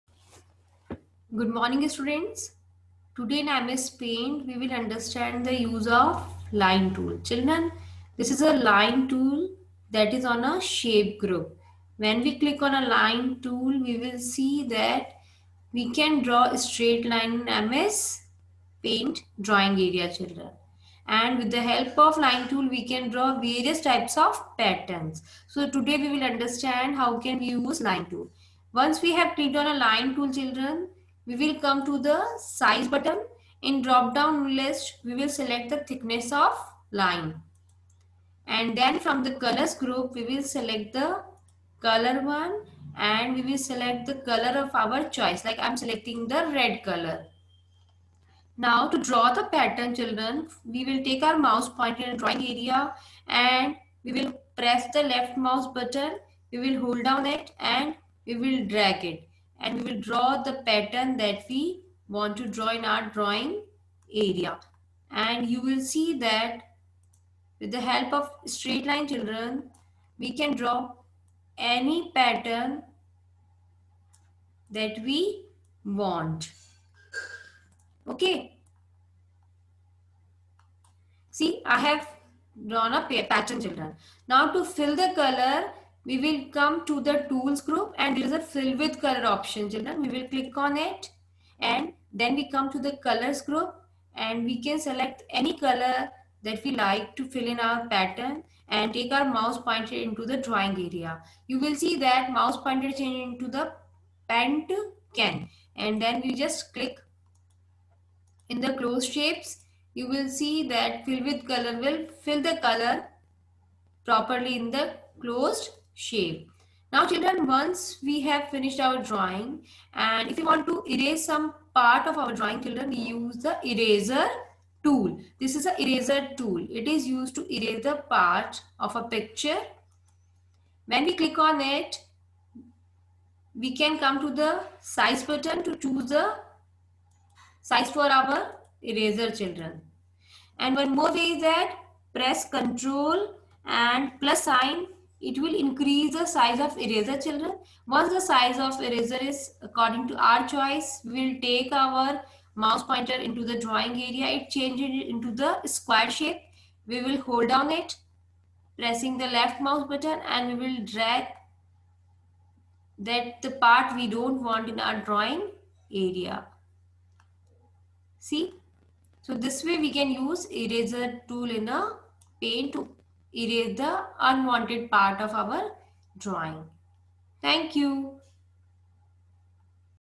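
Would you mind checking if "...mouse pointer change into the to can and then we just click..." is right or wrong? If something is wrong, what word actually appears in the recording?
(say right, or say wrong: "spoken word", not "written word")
right.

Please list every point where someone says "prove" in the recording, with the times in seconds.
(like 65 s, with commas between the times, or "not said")
not said.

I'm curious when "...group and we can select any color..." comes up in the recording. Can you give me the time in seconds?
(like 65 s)
93 s.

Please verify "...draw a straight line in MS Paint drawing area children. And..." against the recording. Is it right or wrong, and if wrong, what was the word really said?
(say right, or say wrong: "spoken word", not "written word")
right.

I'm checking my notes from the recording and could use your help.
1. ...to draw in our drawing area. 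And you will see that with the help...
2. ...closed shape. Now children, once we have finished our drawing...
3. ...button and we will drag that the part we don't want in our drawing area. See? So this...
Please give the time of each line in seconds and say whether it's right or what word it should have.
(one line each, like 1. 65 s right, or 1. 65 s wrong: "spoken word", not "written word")
1. 62 s right
2. 115 s right
3. 159 s right.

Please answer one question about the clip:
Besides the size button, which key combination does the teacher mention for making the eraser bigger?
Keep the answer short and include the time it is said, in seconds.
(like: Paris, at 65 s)
Control and plus, at 142 s.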